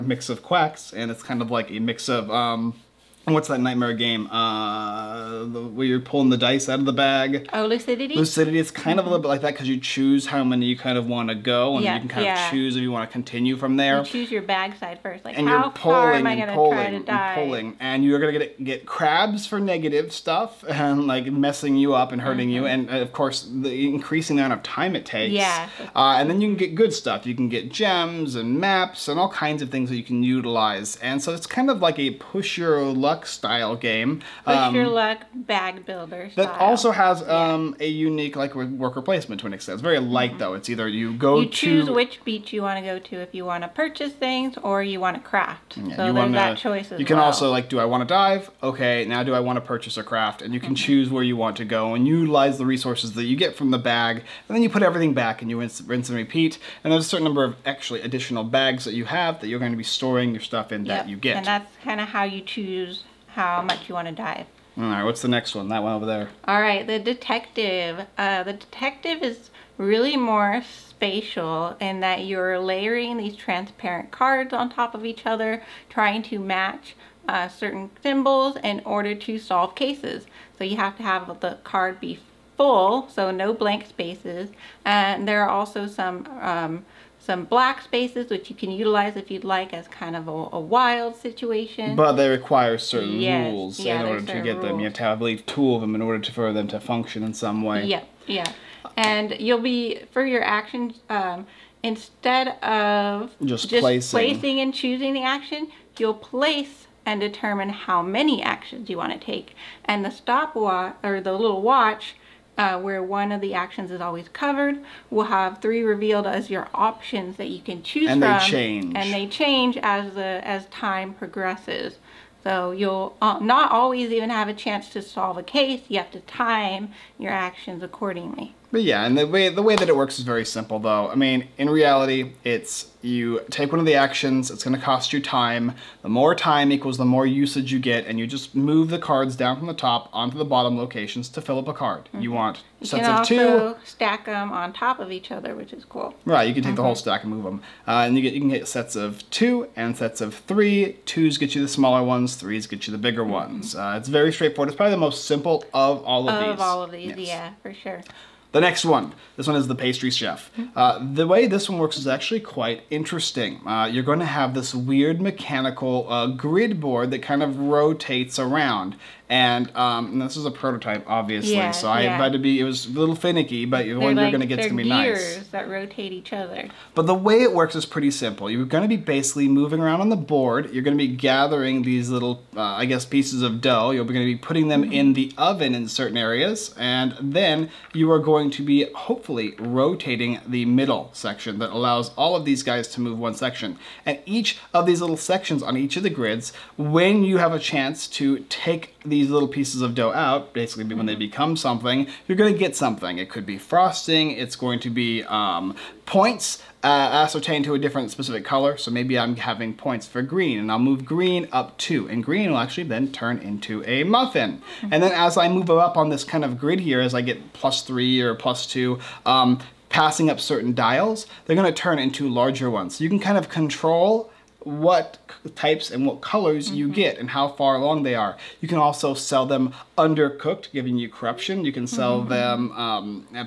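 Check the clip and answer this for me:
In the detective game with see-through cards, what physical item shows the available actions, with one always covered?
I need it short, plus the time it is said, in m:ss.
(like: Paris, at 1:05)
stopwatch, at 1:50.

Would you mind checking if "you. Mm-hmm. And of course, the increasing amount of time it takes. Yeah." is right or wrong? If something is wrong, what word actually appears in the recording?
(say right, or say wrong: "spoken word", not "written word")
right.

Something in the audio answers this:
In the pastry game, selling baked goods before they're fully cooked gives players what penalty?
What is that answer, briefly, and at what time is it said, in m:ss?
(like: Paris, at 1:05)
corruption, at 3:51.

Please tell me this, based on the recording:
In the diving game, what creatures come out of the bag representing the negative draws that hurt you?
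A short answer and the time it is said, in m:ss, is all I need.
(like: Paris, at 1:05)
crabs, at 0:18.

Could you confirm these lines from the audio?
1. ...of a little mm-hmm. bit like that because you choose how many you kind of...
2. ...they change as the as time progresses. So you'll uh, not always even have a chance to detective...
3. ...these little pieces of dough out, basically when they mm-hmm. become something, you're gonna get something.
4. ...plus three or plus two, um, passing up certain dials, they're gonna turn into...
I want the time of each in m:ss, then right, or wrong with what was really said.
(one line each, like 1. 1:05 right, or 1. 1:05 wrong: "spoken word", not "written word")
1. 0:08 right
2. 1:59 wrong: "solve", not "detective"
3. 3:19 right
4. 3:37 right.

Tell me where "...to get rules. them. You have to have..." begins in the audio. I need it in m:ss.
1:34.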